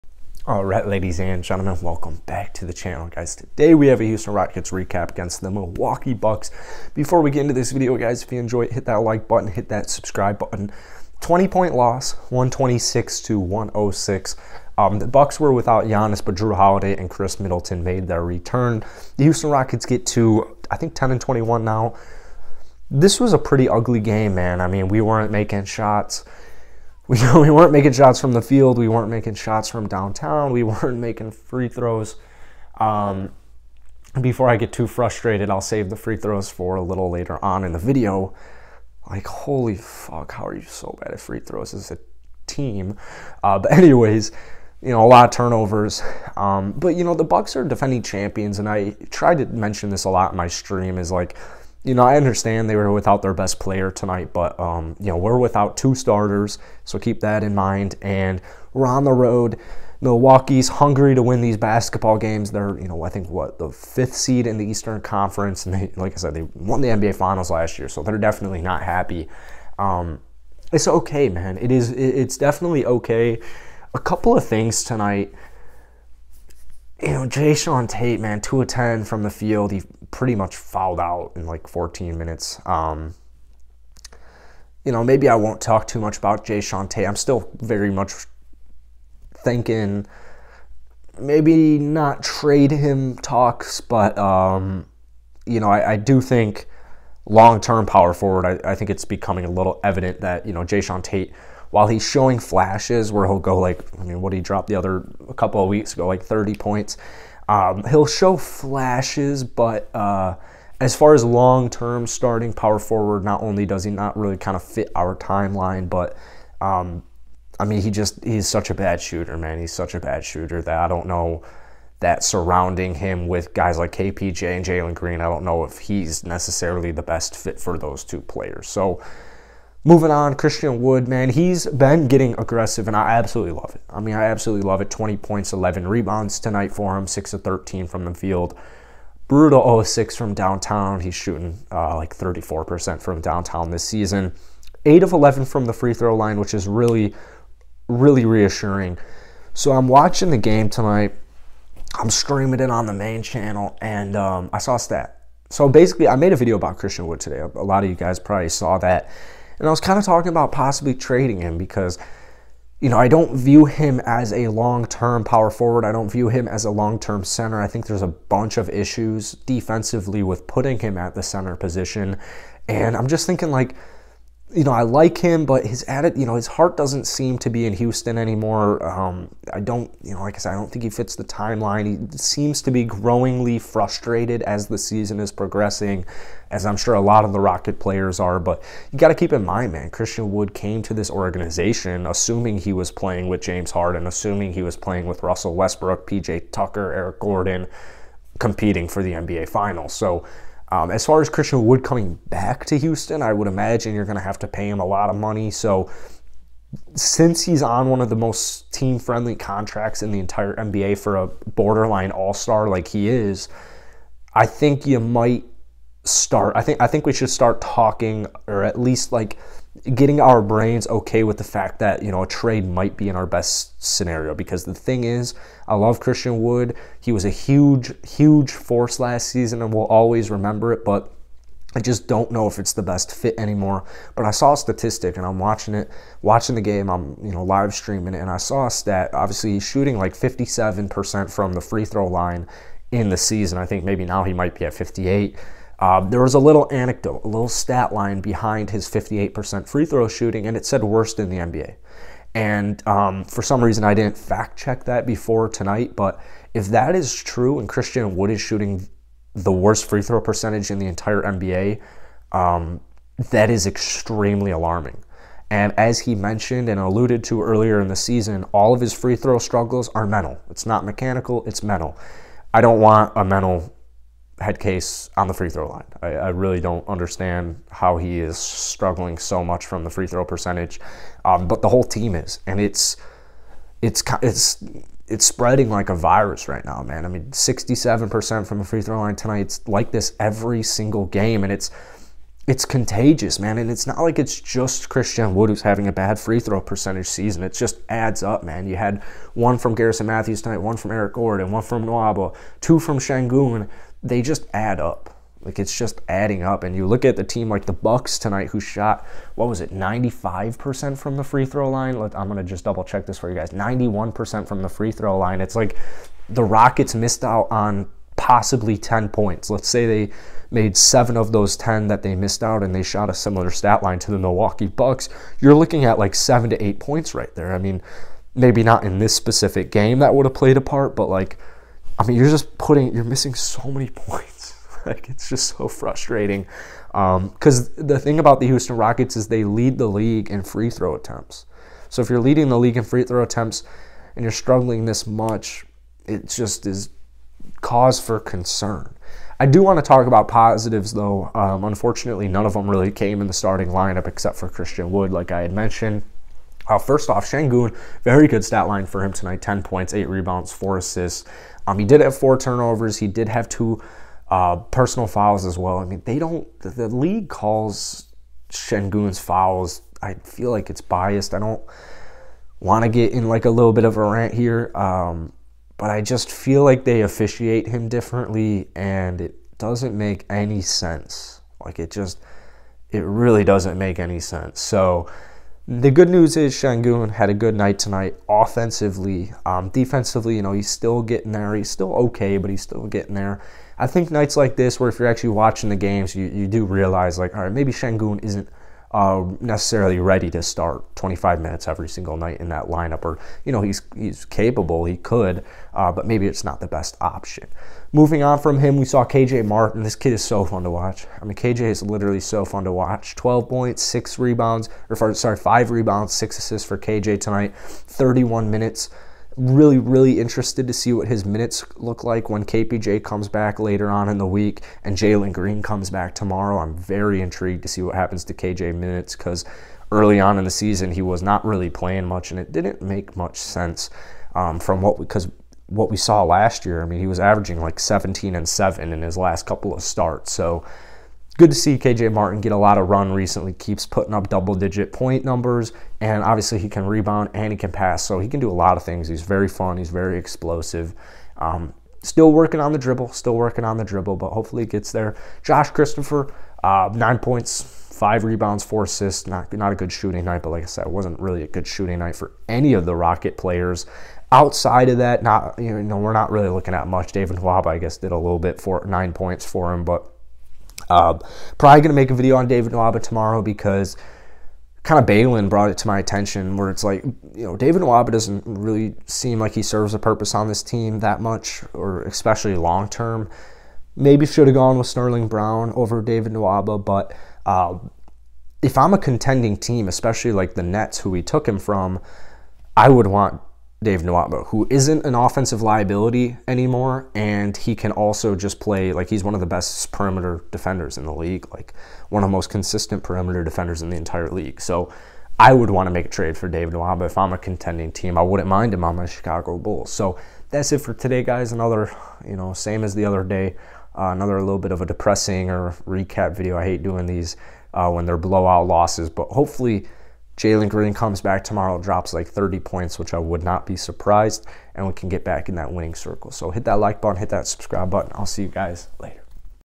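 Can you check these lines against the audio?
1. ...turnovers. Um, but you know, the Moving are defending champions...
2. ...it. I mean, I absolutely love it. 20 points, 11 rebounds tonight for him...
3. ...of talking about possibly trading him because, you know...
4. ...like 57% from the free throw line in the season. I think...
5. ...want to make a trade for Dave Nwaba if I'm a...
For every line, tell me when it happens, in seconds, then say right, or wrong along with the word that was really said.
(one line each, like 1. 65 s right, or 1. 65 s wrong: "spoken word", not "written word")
1. 45 s wrong: "Bucks", not "Moving"
2. 133 s right
3. 159 s right
4. 239 s right
5. 505 s right.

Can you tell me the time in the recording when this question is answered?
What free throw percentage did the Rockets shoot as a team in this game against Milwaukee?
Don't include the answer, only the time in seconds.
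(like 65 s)
287 s.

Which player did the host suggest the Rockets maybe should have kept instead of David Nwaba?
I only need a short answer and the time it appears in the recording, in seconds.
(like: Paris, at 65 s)
Sterling Brown, at 484 s.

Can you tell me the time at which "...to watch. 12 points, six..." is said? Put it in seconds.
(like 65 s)
412 s.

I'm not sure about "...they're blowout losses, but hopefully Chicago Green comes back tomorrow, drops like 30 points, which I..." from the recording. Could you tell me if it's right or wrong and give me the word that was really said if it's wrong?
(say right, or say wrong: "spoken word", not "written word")
wrong: "Jalen", not "Chicago".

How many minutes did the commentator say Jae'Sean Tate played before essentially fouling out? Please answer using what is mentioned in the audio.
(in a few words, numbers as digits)
14.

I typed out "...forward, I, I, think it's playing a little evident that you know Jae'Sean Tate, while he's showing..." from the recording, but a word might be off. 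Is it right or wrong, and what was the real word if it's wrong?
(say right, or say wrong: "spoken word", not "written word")
wrong: "becoming", not "playing".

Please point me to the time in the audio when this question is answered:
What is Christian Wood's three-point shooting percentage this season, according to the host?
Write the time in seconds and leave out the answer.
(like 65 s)
142 s.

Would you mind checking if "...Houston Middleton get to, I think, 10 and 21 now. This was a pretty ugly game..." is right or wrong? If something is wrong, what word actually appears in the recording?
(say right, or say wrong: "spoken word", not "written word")
wrong: "Rockets", not "Middleton".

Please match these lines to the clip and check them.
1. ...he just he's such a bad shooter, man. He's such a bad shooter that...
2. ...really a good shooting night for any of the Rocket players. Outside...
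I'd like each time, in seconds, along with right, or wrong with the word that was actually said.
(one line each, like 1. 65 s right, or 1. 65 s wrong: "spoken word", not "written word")
1. 117 s right
2. 461 s right.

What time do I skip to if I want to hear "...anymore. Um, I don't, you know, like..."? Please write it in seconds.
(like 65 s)
178 s.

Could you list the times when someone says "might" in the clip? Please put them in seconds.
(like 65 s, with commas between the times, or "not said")
215 s, 222 s, 244 s.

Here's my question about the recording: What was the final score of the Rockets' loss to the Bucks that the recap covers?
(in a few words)
126 to 106.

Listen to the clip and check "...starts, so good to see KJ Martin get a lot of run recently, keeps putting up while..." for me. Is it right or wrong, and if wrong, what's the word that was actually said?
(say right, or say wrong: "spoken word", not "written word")
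wrong: "double", not "while".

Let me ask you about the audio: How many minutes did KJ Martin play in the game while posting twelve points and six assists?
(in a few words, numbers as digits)
31.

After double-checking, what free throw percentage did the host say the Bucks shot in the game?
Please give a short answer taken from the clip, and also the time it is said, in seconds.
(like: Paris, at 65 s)
91%, at 313 s.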